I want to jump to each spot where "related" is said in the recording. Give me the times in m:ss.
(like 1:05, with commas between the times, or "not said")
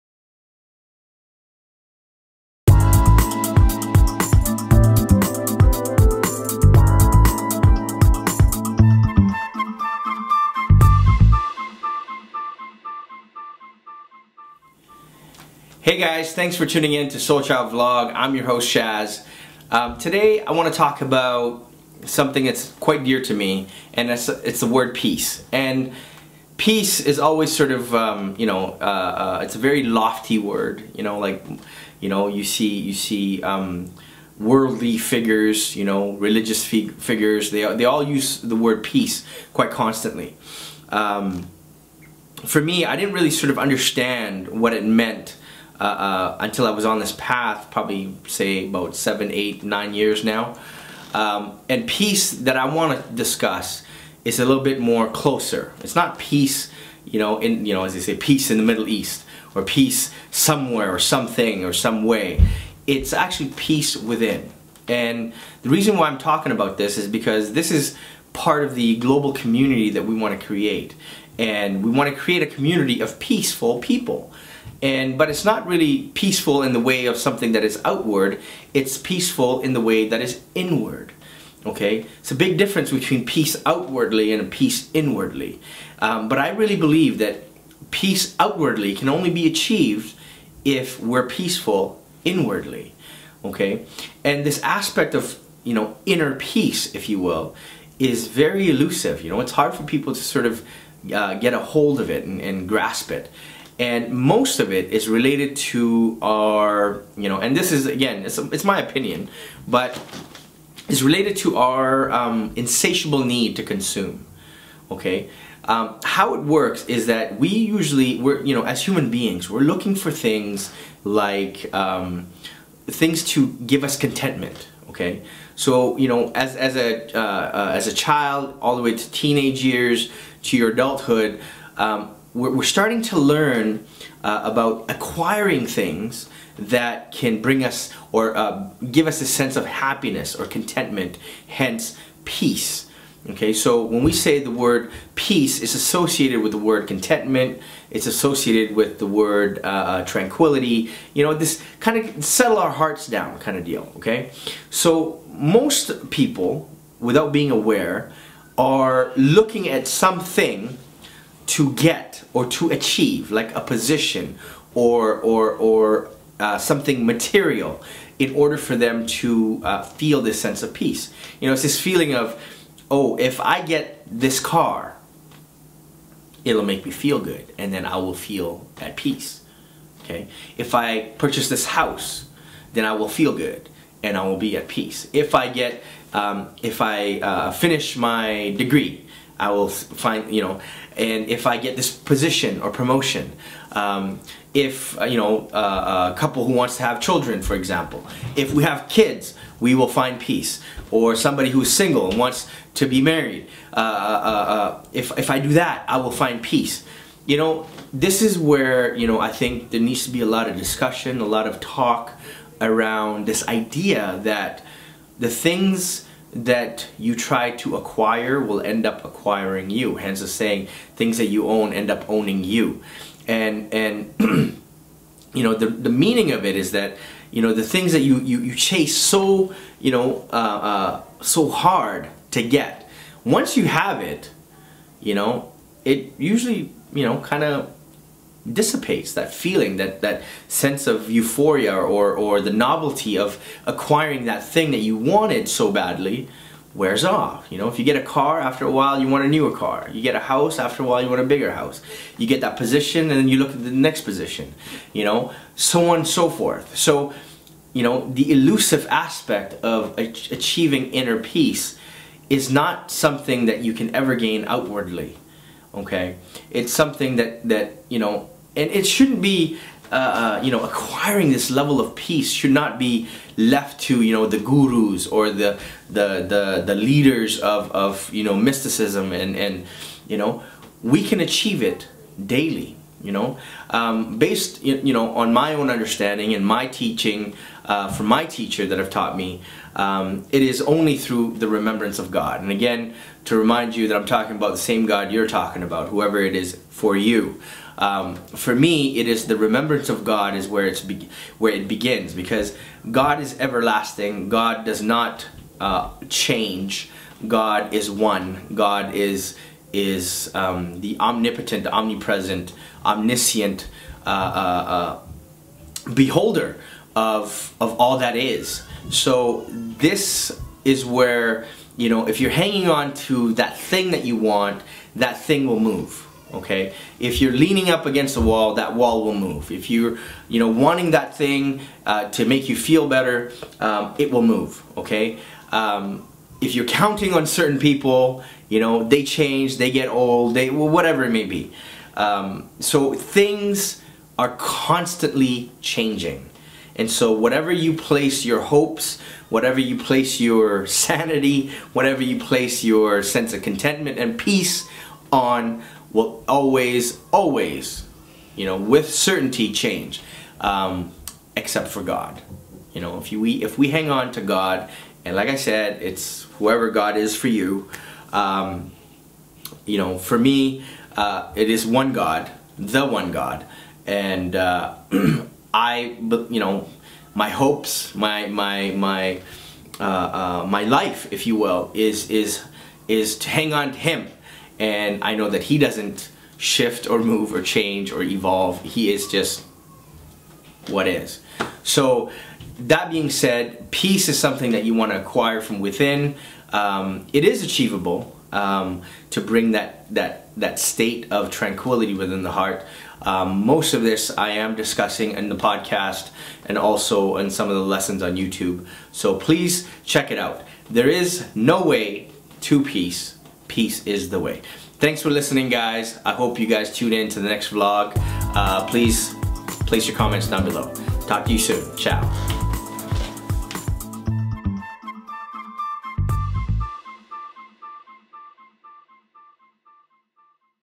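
1:45, 1:51.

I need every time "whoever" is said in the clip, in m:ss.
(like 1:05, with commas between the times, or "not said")
4:55, 6:06.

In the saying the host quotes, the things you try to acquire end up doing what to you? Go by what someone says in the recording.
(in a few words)
acquiring you.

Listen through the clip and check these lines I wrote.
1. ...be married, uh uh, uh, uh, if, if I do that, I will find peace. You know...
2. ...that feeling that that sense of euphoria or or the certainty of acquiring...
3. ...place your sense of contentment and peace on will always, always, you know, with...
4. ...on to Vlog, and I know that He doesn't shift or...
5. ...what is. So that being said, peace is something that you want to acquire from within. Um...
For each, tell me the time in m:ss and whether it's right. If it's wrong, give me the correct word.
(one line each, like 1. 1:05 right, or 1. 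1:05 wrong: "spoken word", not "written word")
1. 3:22 right
2. 3:59 wrong: "novelty", not "certainty"
3. 5:52 right
4. 6:23 wrong: "Him", not "Vlog"
5. 6:30 right.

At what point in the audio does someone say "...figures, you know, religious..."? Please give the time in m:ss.
0:34.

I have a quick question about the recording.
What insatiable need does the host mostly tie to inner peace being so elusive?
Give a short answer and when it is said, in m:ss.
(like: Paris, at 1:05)
consume, at 1:53.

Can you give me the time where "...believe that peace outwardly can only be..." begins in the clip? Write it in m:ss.
1:26.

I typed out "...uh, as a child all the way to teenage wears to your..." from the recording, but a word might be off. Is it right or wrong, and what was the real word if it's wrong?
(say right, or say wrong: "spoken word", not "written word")
wrong: "years", not "wears".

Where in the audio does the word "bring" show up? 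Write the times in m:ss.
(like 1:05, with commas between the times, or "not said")
2:17, 6:39.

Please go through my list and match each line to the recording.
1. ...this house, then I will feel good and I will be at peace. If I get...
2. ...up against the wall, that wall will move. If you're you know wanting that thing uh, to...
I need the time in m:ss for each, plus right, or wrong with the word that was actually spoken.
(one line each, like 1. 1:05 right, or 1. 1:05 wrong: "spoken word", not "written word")
1. 3:01 right
2. 5:27 right.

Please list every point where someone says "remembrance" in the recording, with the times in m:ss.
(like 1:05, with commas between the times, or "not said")
4:51, 4:59.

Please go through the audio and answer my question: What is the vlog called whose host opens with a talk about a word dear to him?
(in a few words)
SoulChow Vlog.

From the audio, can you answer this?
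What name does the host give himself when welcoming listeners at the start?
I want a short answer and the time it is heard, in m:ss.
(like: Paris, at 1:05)
Shaz, at 0:18.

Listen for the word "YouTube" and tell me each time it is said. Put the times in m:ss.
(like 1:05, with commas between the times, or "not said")
6:48.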